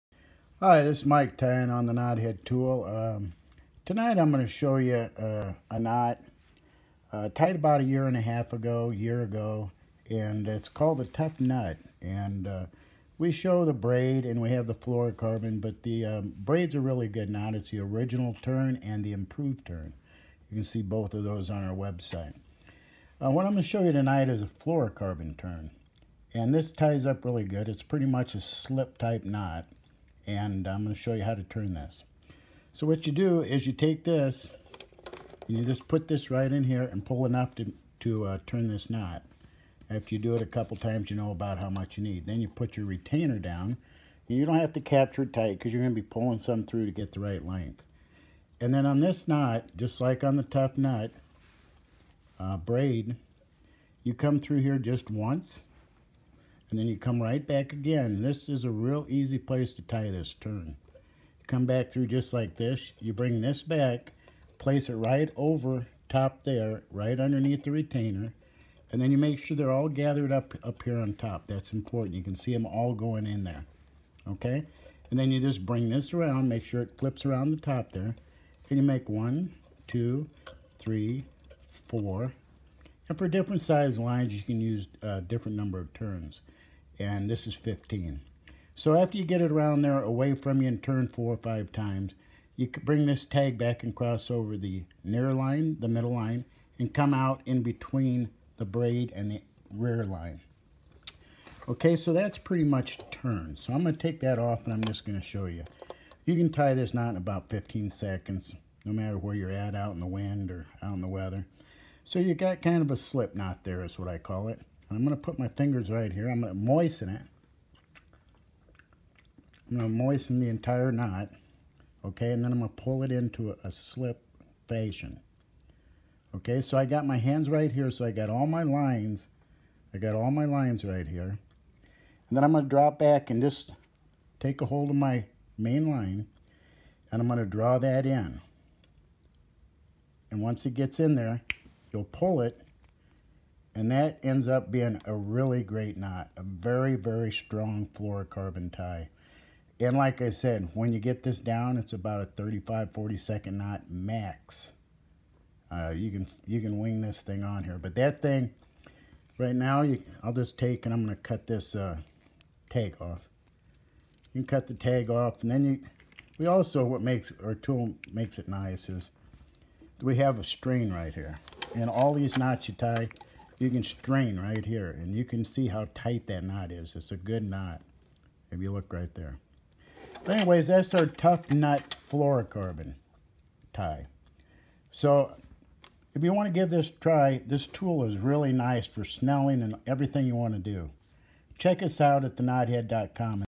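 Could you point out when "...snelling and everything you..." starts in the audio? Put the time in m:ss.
3:09.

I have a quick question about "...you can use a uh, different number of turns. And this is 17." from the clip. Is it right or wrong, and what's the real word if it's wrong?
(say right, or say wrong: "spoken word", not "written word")
wrong: "15", not "17".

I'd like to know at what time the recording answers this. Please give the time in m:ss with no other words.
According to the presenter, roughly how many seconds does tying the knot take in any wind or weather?
1:47.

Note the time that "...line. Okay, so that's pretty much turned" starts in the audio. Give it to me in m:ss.
1:40.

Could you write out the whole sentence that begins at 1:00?
You come back through just like this.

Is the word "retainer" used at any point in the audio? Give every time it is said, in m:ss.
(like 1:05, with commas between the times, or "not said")
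0:42, 1:07.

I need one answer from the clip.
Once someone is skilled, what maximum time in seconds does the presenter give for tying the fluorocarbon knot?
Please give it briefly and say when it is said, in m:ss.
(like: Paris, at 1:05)
40, at 2:32.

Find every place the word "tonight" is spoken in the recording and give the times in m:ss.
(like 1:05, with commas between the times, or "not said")
0:03, 0:23.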